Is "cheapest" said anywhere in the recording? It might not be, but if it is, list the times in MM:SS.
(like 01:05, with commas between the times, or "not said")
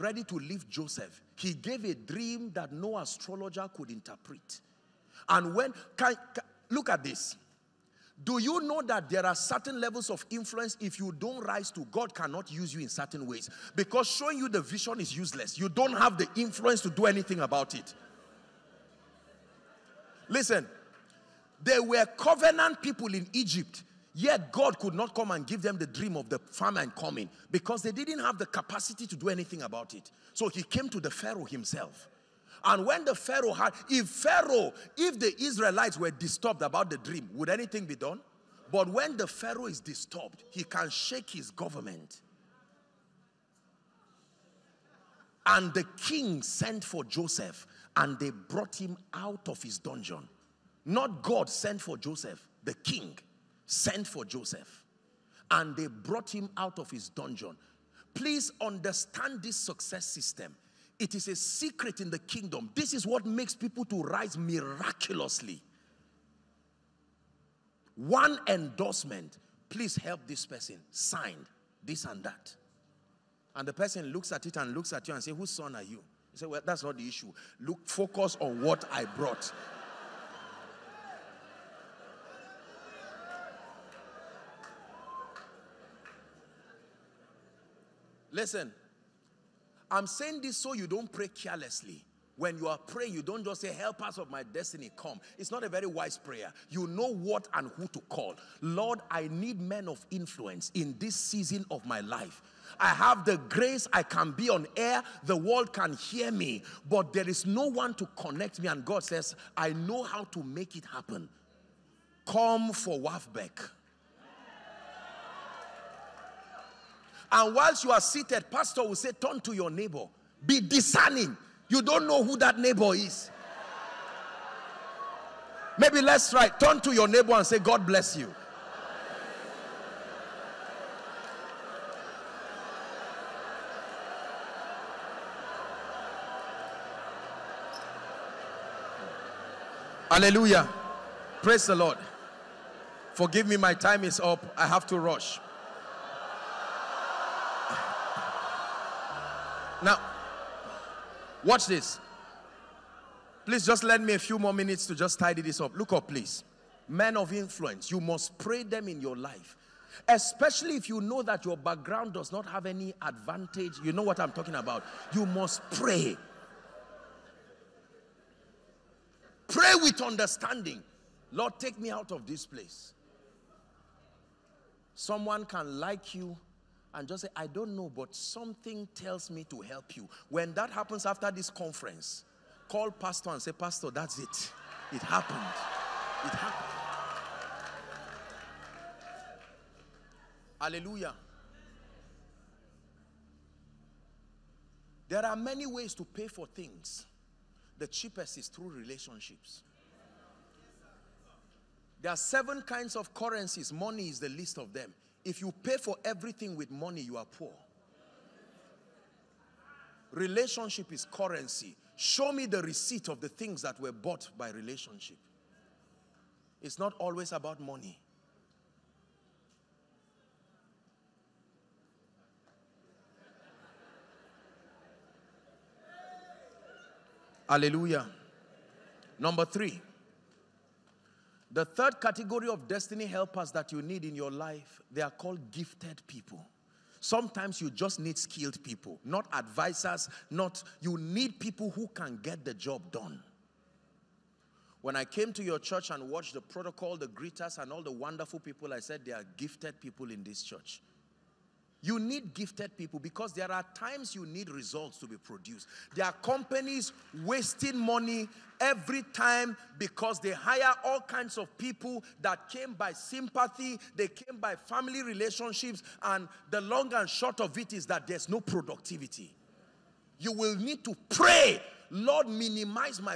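03:17.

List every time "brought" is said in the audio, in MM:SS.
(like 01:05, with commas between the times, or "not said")
00:48, 00:55, 01:19.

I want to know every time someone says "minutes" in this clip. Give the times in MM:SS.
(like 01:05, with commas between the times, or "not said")
02:34.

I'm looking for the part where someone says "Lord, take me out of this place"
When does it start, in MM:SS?
02:51.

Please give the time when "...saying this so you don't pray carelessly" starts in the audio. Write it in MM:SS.
01:30.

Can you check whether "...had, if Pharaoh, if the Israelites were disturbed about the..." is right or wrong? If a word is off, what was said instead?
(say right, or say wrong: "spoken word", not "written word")
right.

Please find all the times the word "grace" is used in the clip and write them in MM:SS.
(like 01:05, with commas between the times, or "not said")
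01:43.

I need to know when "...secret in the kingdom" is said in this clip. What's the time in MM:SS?
01:01.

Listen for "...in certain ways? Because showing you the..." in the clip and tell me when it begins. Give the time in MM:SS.
00:12.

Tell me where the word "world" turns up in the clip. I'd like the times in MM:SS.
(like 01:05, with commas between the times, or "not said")
01:45.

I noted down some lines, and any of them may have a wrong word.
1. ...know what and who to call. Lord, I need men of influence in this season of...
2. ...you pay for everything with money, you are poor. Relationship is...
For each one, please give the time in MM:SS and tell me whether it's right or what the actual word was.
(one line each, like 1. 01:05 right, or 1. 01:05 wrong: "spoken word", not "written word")
1. 01:36 right
2. 03:25 right.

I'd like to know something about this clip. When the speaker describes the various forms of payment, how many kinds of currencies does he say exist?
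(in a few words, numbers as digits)
7.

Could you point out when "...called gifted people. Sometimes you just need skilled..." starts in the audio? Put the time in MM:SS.
03:55.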